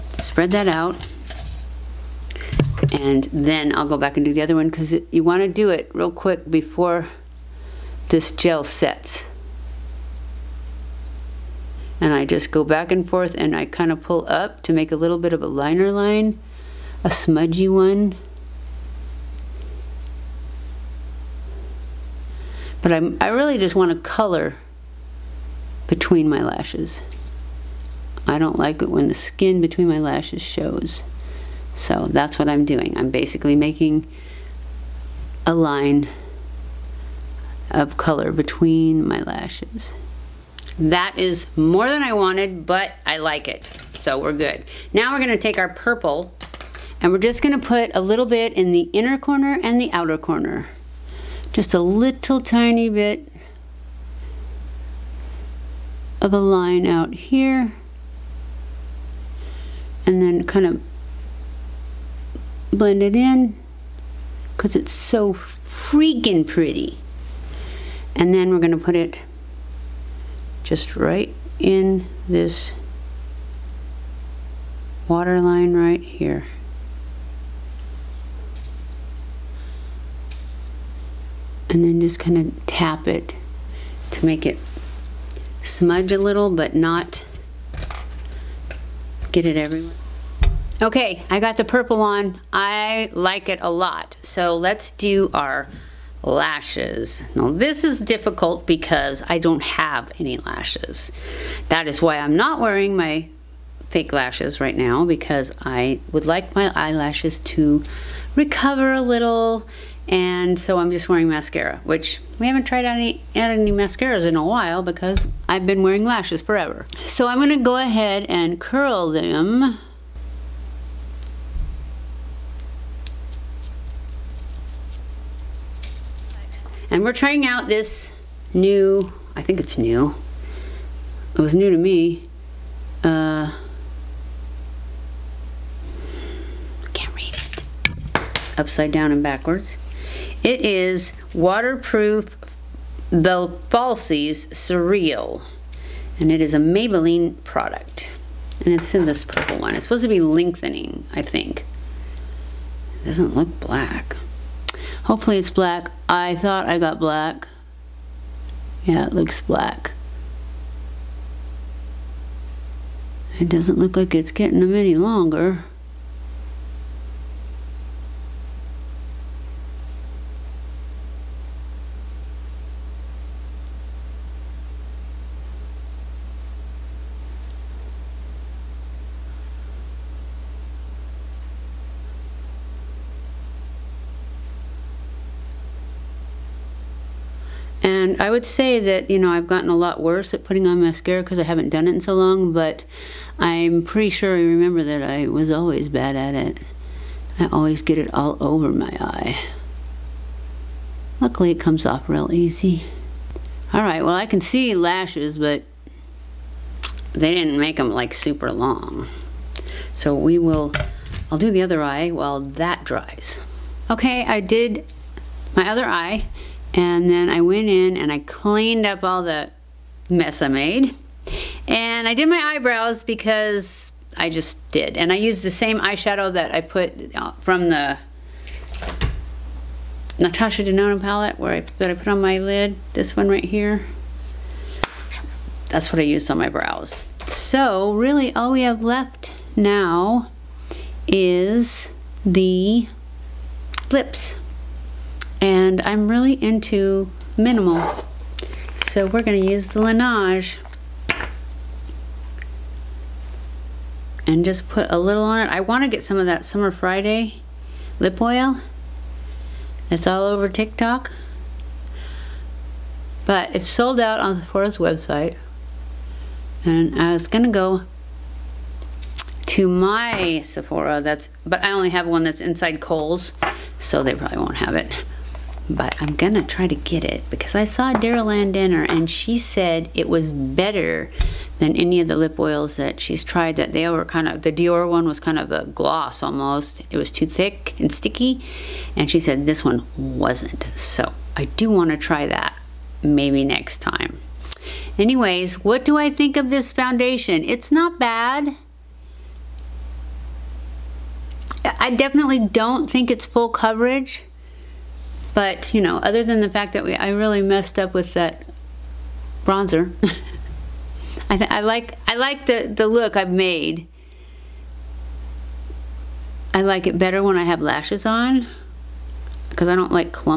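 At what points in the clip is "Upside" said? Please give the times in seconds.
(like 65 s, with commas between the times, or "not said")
138 s.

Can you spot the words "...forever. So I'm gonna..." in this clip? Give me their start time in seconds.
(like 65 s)
116 s.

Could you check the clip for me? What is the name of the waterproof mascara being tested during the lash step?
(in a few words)
The Falsies Surreal.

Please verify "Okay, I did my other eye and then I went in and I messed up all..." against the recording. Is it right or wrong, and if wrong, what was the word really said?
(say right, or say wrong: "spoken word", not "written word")
wrong: "cleaned", not "messed".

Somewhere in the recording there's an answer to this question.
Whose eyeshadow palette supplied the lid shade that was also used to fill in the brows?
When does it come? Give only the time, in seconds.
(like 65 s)
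230 s.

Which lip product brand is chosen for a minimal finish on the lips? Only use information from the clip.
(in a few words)
Laneige.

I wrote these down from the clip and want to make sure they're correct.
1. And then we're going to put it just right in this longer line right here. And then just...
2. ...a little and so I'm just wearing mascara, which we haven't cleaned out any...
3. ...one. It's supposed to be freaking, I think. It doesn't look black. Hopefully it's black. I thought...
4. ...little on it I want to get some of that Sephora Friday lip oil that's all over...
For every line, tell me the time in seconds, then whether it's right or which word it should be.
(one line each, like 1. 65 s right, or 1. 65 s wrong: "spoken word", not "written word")
1. 68 s wrong: "water", not "longer"
2. 108 s wrong: "tried", not "cleaned"
3. 149 s wrong: "lengthening", not "freaking"
4. 254 s wrong: "Summer", not "Sephora".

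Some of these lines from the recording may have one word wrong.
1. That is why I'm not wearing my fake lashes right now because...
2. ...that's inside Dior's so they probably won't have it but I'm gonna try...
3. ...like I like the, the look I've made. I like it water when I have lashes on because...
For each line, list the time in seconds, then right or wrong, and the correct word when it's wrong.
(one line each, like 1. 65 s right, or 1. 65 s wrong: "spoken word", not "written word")
1. 101 s right
2. 272 s wrong: "Kohl", not "Dior"
3. 311 s wrong: "better", not "water".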